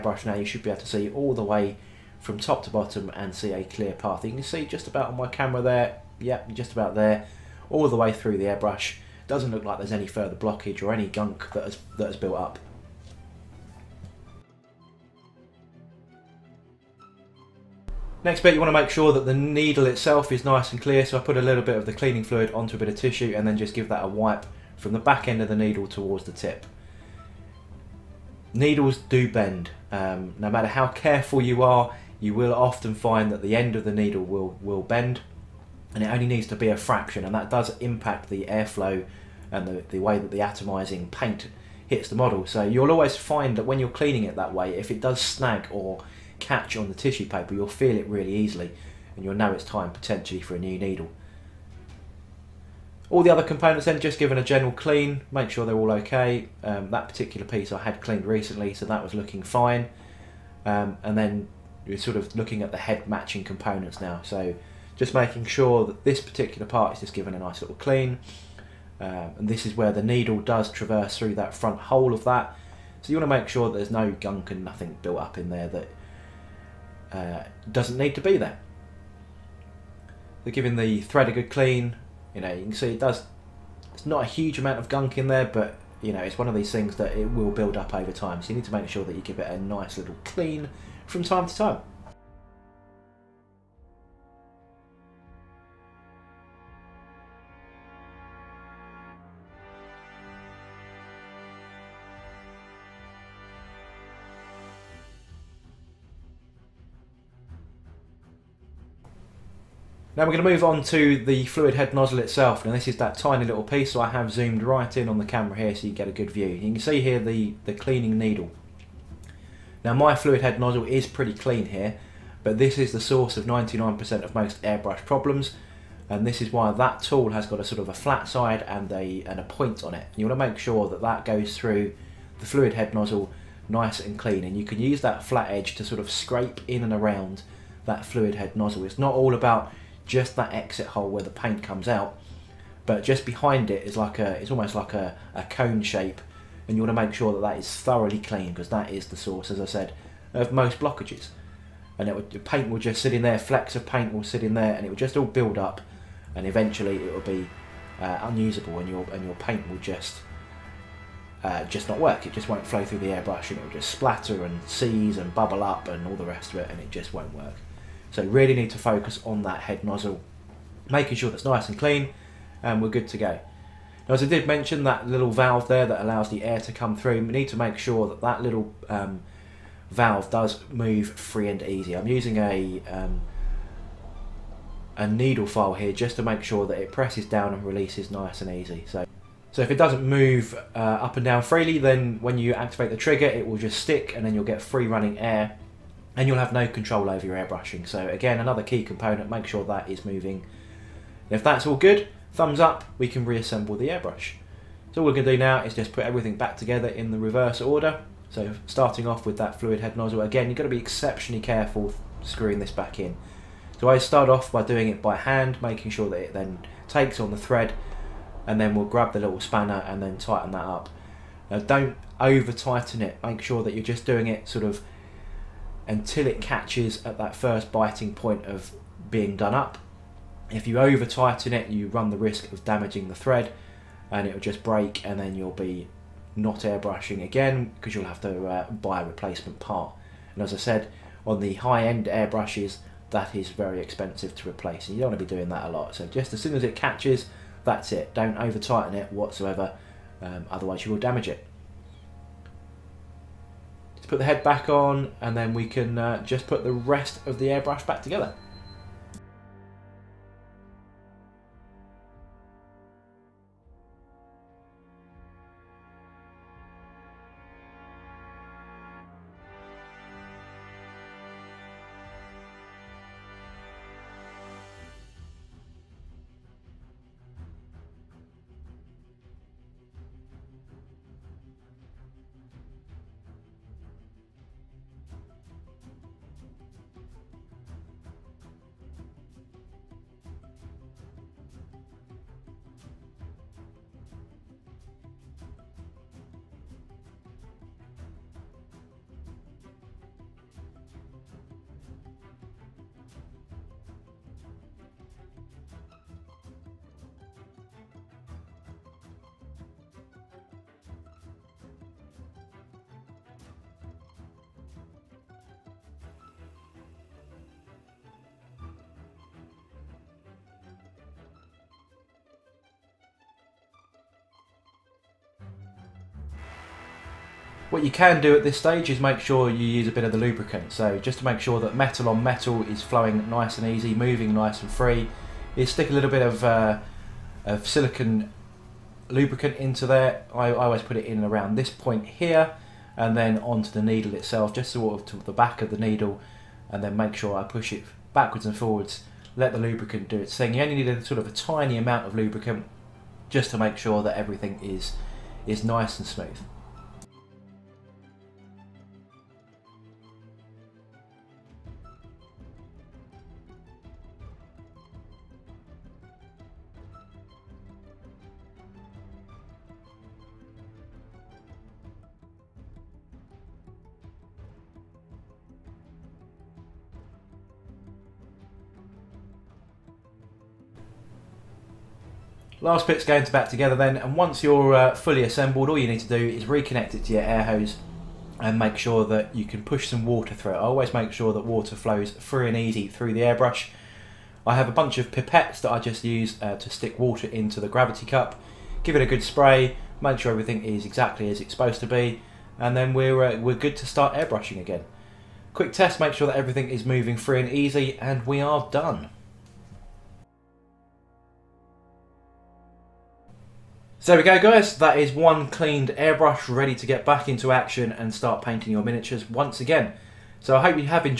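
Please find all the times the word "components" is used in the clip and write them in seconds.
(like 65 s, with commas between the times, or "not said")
53 s, 63 s, 198 s.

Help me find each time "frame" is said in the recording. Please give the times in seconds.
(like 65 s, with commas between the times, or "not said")
not said.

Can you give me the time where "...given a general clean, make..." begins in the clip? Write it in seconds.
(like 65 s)
54 s.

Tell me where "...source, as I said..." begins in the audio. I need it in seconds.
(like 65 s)
149 s.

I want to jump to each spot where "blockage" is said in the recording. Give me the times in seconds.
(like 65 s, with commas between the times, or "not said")
10 s, 150 s.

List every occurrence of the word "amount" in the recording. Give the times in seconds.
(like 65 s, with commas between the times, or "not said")
84 s, 351 s.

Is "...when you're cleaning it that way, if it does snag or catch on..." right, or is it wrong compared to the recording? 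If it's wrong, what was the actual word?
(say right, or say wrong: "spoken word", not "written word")
right.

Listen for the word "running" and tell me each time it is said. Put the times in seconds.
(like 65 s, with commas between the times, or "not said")
194 s.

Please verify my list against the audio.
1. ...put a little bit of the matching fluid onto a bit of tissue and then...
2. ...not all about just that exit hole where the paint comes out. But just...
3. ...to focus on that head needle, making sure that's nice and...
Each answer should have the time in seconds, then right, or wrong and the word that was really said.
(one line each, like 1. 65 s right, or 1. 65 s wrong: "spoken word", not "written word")
1. 21 s wrong: "cleaning", not "matching"
2. 138 s right
3. 168 s wrong: "nozzle", not "needle".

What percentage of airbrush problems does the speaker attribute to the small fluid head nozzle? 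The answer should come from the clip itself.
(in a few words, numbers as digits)
99%.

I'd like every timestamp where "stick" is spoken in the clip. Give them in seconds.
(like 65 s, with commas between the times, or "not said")
193 s, 335 s, 396 s.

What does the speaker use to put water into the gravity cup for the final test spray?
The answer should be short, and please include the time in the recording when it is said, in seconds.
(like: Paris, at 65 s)
pipettes, at 395 s.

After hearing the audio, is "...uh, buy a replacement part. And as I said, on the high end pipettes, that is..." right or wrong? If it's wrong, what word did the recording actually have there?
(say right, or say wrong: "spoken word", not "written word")
wrong: "airbrushes", not "pipettes".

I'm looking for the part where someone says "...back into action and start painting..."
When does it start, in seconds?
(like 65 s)
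417 s.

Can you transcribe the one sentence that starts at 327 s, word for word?
What you can do at this stage is make sure you use a bit of the lubricant.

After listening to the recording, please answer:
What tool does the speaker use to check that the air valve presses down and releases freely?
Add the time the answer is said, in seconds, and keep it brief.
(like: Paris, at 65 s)
a needle file, at 184 s.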